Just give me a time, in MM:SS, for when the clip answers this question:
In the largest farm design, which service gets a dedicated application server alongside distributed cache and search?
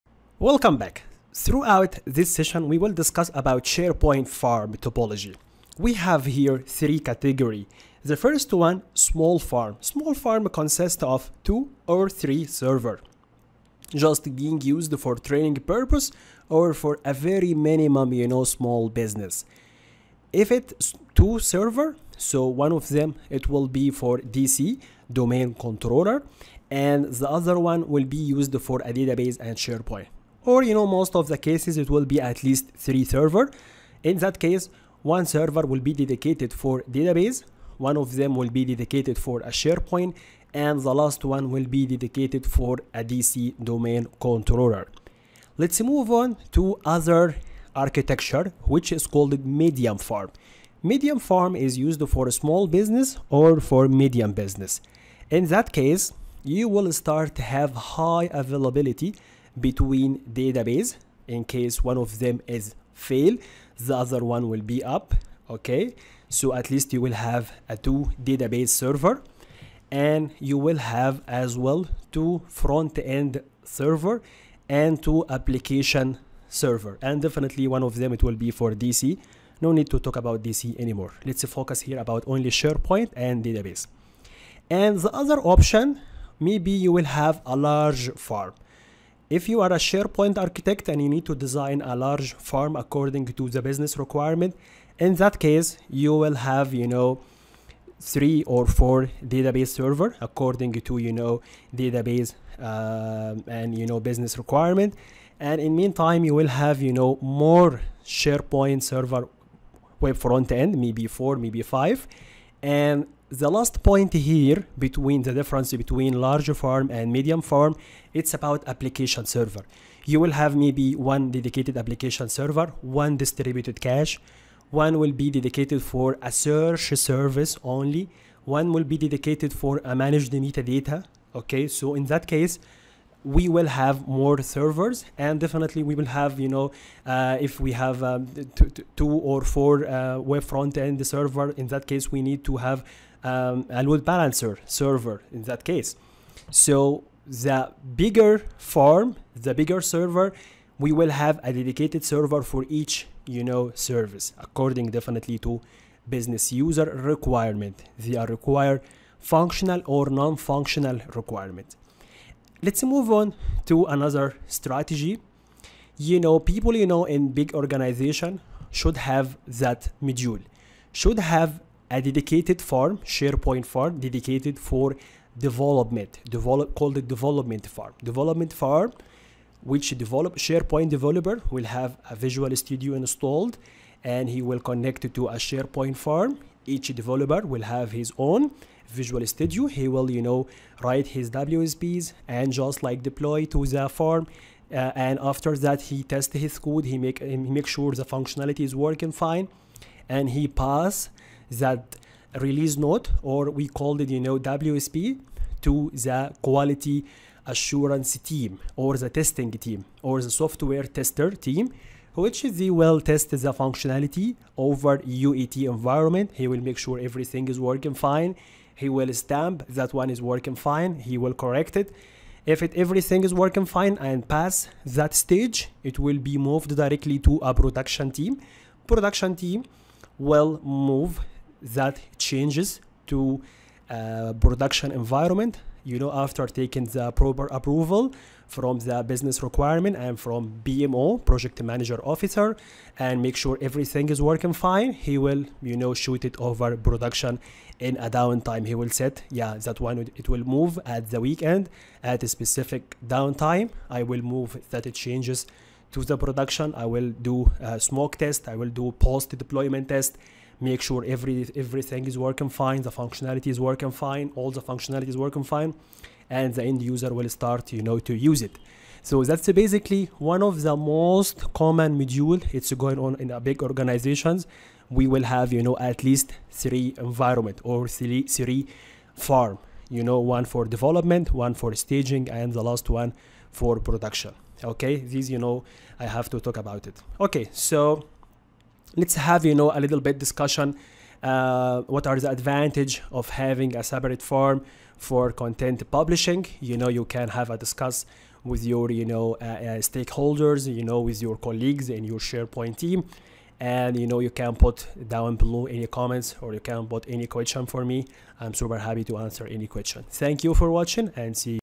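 02:09.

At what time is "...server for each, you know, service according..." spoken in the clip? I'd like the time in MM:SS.
02:32.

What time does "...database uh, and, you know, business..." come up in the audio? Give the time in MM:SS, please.
01:41.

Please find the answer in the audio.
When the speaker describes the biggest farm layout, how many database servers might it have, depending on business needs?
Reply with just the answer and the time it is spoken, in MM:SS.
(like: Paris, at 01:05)
3 or 4, at 01:38.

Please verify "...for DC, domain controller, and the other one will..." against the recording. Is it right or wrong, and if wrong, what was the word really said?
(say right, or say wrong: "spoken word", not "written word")
right.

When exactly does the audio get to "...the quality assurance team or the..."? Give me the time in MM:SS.
03:25.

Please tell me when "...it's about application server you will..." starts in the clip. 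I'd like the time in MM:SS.
01:58.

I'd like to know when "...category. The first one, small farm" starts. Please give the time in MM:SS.
00:06.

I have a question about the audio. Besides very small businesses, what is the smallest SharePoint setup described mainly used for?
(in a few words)
Training.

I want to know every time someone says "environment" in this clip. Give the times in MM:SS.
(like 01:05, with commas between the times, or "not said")
03:35, 03:54, 04:36.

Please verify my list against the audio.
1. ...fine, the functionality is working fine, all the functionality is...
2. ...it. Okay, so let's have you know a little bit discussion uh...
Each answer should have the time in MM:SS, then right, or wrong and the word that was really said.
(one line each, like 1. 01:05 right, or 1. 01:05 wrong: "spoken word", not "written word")
1. 04:22 right
2. 04:46 right.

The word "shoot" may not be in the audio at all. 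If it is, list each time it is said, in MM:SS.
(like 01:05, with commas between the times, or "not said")
04:05.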